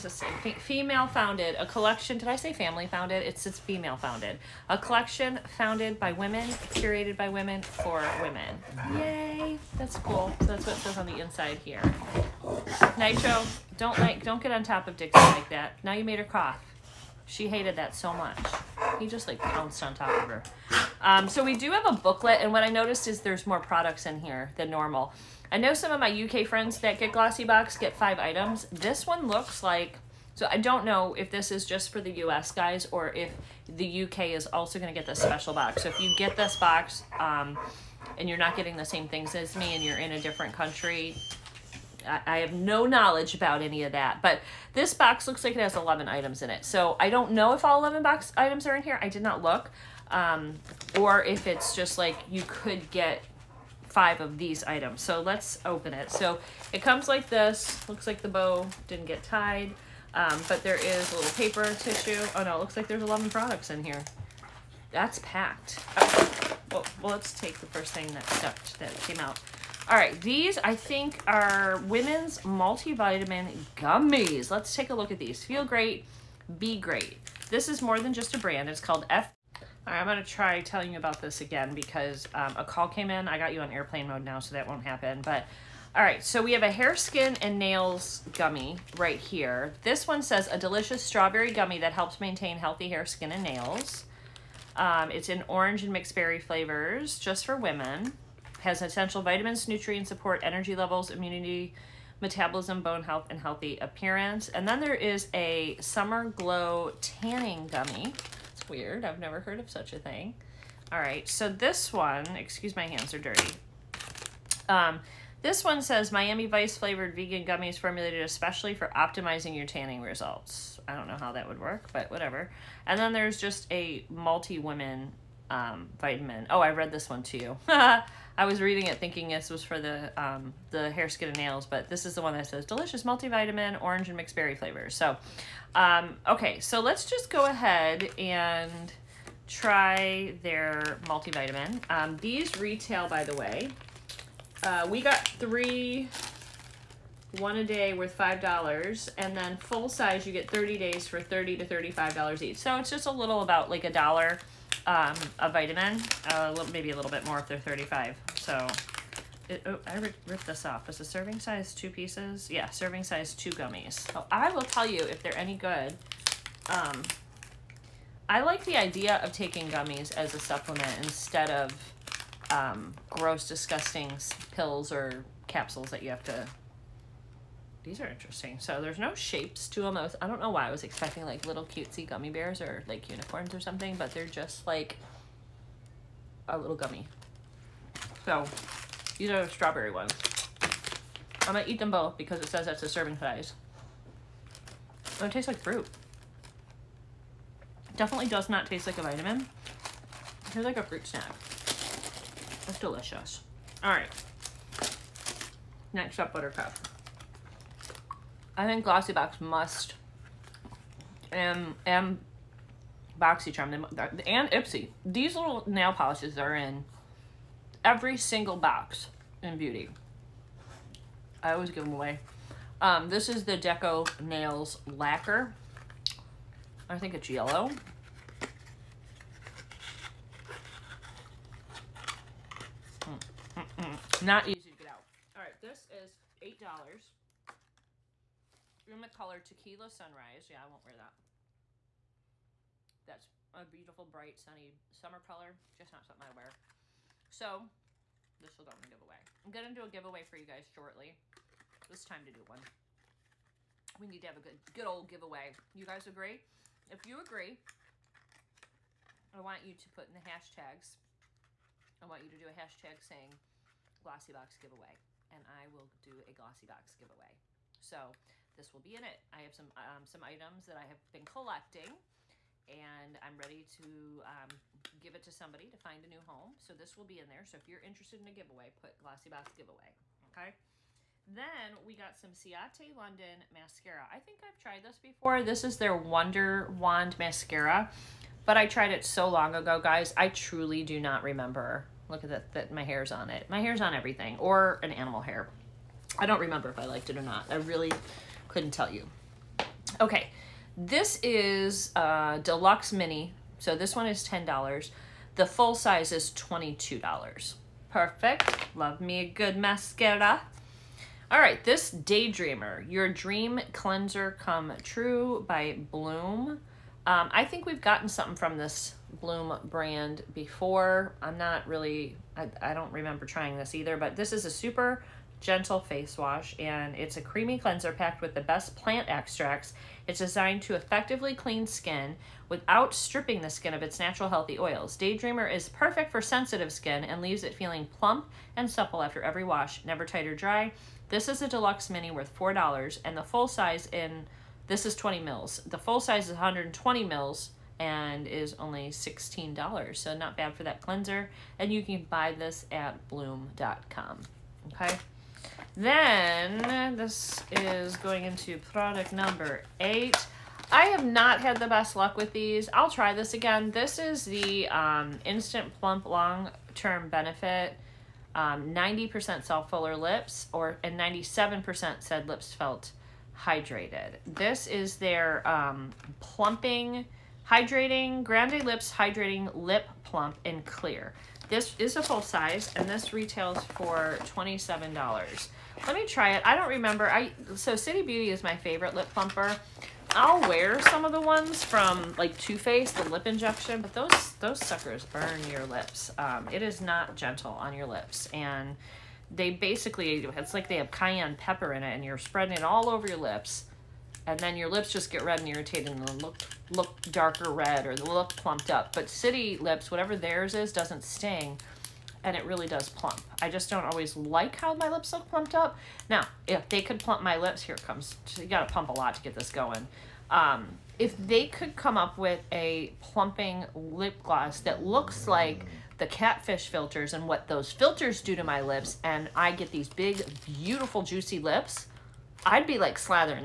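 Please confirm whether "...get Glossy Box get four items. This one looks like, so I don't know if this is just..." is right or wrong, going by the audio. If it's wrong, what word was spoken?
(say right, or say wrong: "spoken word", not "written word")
wrong: "five", not "four".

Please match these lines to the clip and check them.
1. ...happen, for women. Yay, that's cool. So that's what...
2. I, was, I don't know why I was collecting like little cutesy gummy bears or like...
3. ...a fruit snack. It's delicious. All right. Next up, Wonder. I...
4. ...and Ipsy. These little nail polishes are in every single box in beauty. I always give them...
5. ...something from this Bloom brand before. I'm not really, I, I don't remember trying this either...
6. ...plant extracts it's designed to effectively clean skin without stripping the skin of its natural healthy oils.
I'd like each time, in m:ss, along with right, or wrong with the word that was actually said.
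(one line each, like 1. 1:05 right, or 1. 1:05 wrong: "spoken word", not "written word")
1. 0:07 wrong: "women", not "happen"
2. 2:59 wrong: "expecting", not "collecting"
3. 3:20 wrong: "Buttercup", not "Wonder"
4. 3:34 right
5. 5:18 right
6. 5:28 right.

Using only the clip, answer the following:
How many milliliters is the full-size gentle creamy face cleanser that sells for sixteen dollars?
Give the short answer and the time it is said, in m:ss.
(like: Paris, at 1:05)
120 ml, at 5:46.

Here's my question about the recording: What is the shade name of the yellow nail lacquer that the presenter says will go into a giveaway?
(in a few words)
Tequila Sunrise.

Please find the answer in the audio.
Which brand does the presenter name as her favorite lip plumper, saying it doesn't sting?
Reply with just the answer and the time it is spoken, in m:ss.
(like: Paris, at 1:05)
City Beauty, at 6:27.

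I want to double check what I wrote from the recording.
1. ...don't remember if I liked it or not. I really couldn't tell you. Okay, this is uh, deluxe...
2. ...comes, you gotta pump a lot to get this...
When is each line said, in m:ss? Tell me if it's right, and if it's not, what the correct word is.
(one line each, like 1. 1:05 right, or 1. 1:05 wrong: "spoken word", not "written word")
1. 4:56 right
2. 6:57 right.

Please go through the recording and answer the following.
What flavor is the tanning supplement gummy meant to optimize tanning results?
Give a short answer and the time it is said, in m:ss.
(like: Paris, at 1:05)
Miami Vice, at 1:56.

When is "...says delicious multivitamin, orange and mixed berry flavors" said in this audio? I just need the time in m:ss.
2:12.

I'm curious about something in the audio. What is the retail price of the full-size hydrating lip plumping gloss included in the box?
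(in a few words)
$27.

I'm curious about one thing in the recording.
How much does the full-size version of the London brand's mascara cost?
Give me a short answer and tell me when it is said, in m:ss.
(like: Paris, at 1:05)
$22, at 5:06.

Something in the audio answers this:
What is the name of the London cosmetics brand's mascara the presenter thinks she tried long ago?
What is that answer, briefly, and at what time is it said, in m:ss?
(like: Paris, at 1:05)
Wonder Wand, at 4:45.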